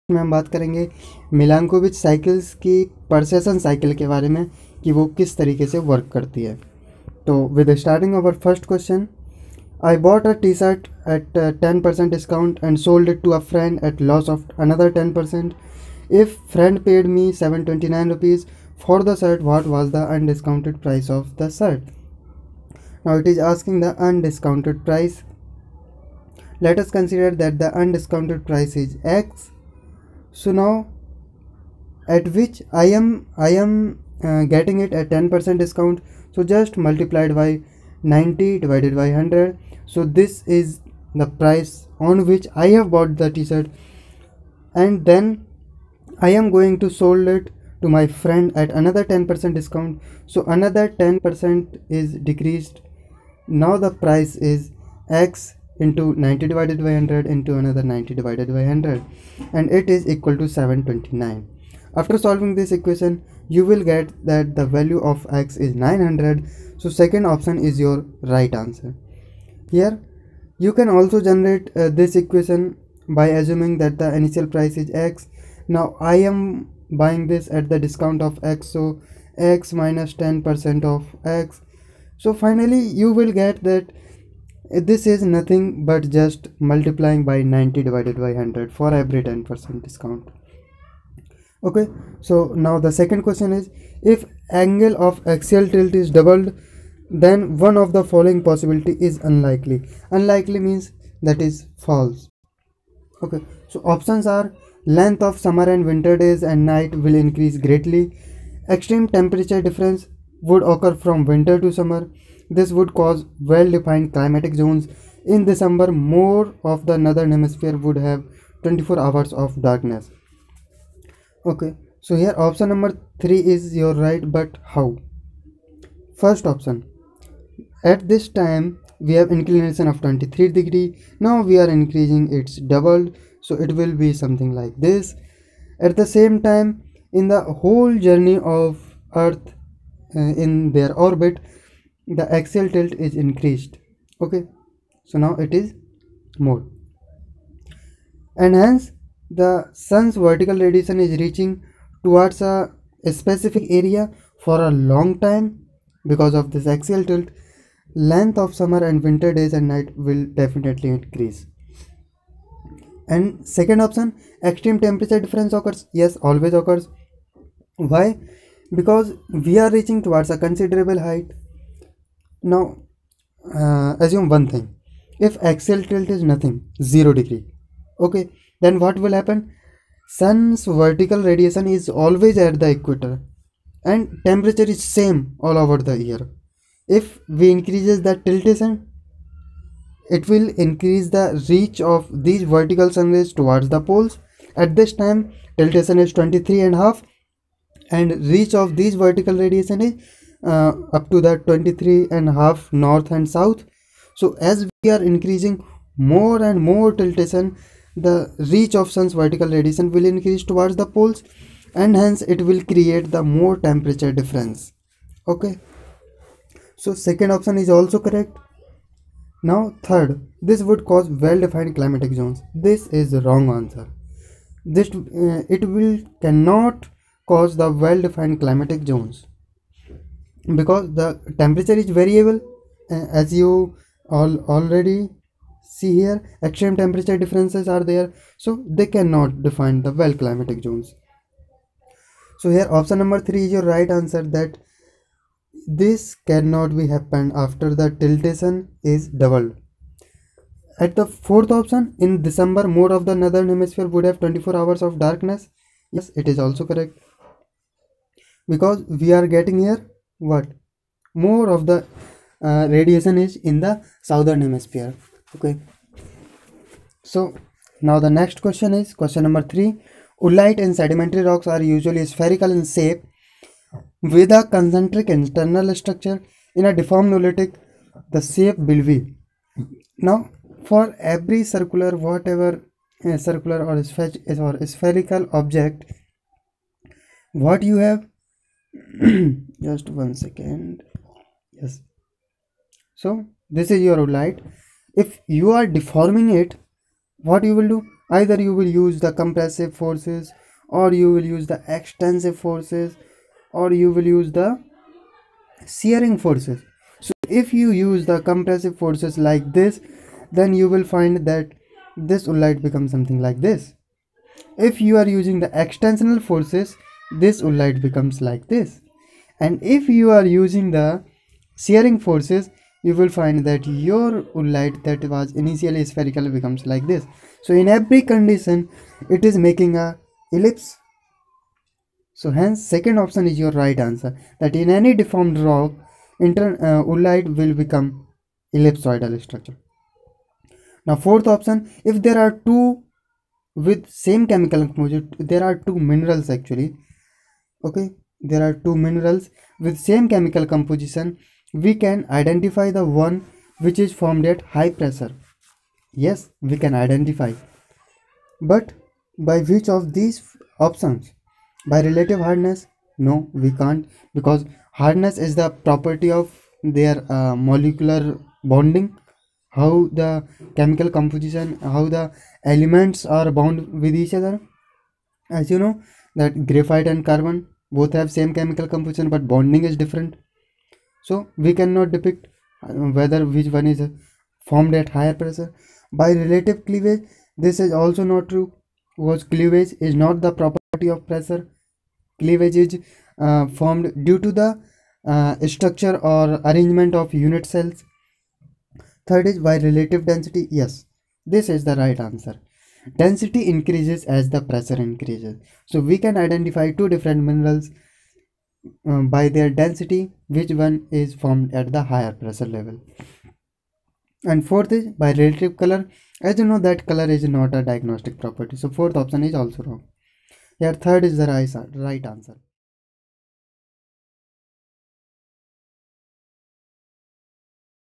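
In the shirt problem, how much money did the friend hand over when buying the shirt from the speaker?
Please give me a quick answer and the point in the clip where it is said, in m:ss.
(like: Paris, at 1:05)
729 rupees, at 0:17.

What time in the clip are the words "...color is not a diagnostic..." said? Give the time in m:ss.
6:56.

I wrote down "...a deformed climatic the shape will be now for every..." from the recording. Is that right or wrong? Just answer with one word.
wrong.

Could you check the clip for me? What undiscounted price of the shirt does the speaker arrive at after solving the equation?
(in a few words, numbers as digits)
900.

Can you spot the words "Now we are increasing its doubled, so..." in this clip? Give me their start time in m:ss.
2:11.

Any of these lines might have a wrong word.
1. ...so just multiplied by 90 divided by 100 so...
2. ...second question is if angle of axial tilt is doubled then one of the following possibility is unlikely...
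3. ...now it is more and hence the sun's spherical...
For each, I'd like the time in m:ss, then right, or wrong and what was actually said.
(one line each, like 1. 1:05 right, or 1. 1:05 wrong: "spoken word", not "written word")
1. 0:36 right
2. 1:32 right
3. 2:25 wrong: "vertical", not "spherical".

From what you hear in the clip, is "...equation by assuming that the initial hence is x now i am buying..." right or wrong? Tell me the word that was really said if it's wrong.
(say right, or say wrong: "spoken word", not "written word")
wrong: "price", not "hence".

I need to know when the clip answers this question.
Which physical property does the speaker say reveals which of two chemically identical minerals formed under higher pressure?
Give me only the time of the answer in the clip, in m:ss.
6:39.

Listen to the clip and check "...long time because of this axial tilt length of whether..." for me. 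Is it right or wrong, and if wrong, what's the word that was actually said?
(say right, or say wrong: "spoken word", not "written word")
wrong: "summer", not "whether".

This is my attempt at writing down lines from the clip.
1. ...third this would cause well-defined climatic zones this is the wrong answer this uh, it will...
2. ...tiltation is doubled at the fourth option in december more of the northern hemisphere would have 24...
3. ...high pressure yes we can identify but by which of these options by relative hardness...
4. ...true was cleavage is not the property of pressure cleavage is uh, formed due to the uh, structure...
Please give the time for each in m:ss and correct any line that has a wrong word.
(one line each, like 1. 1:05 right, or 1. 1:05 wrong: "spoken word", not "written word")
1. 3:39 right
2. 4:07 right
3. 5:54 right
4. 6:28 right.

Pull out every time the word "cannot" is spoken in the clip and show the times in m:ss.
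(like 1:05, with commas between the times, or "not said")
3:46, 3:58, 4:06, 6:21.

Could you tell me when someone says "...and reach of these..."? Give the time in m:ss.
3:17.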